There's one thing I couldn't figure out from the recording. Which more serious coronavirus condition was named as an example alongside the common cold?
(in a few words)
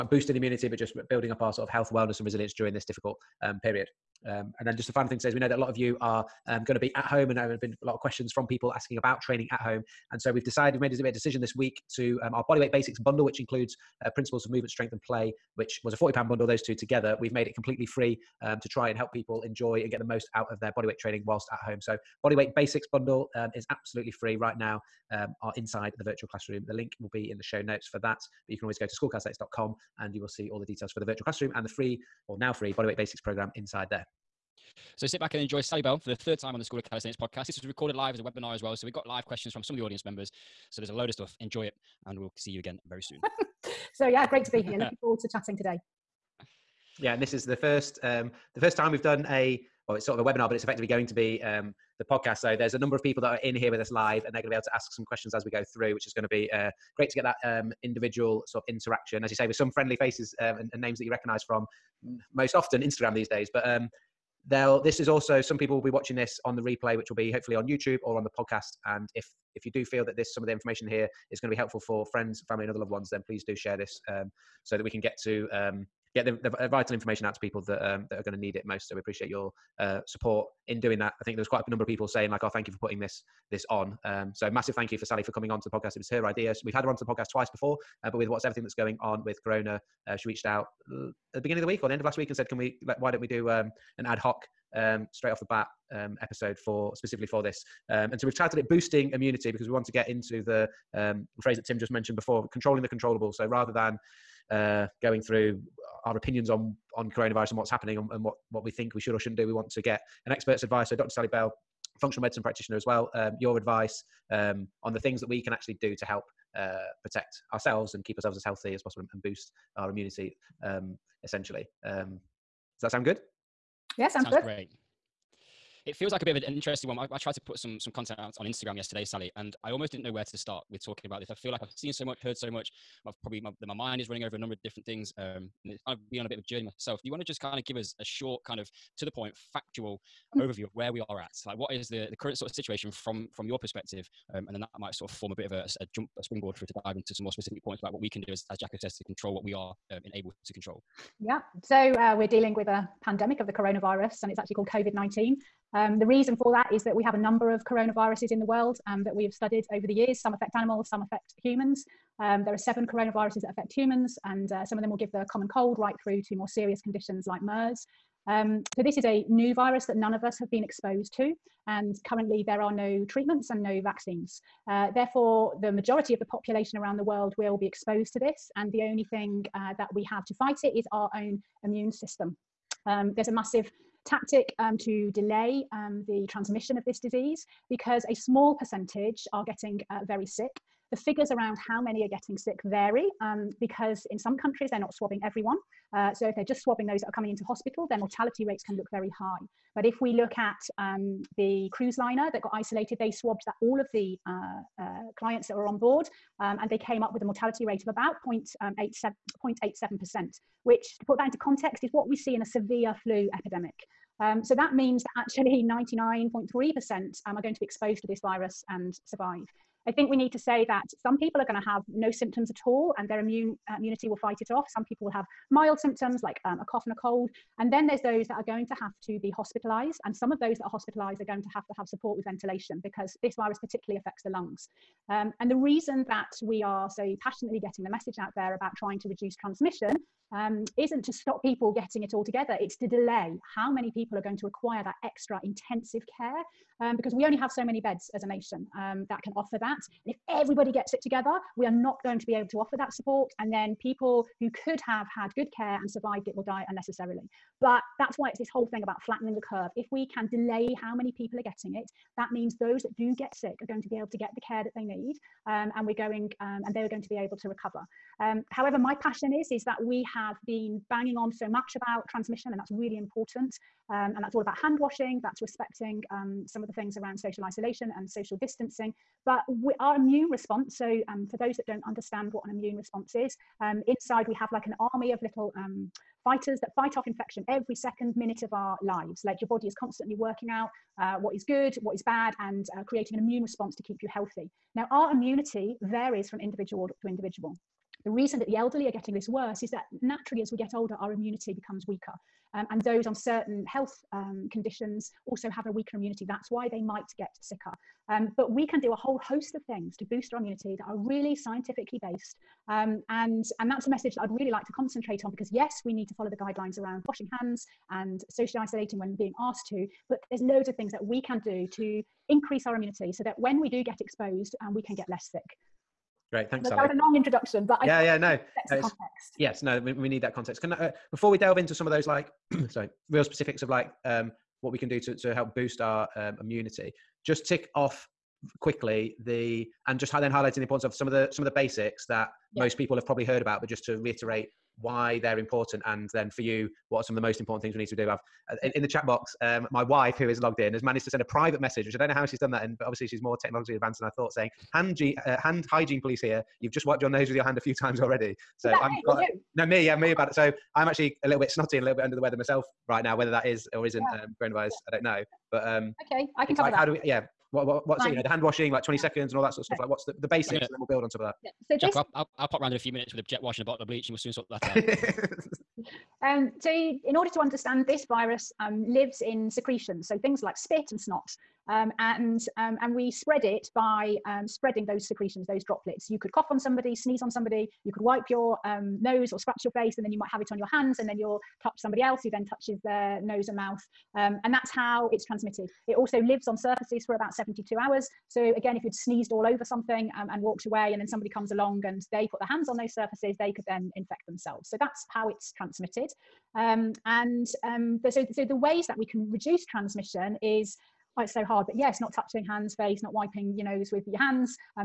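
MERS.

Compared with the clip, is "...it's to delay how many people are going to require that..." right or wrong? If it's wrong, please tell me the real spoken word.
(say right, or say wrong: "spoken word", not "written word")
right.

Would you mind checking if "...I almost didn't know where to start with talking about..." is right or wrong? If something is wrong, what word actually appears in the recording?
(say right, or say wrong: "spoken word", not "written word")
right.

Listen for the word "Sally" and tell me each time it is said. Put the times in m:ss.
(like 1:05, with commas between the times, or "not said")
0:35, 1:25, 1:51, 2:09.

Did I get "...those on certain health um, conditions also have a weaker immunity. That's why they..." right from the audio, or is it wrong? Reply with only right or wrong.
right.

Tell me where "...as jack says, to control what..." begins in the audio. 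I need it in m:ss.
2:28.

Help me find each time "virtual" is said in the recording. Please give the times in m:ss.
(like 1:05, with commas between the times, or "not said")
0:26, 0:31.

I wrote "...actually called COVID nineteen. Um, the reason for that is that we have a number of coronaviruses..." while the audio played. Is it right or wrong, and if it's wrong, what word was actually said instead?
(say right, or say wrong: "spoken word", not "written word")
right.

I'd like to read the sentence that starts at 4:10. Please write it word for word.
And if everybody gets it together, we are not going to be able to offer that support.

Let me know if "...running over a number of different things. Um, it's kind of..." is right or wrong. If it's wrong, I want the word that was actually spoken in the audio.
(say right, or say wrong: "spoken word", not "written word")
right.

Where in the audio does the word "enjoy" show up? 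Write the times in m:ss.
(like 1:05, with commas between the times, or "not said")
0:19, 0:35, 0:41.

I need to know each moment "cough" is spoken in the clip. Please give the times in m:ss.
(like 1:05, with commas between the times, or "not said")
3:46, 6:26.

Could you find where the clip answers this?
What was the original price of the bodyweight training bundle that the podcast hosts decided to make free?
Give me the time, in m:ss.
0:15.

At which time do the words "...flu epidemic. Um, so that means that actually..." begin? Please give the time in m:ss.
3:33.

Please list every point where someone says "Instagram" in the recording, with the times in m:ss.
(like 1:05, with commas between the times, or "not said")
1:02, 2:08.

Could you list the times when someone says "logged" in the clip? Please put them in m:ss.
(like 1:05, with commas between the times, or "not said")
5:50.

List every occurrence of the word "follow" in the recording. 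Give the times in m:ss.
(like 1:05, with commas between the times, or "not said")
5:16.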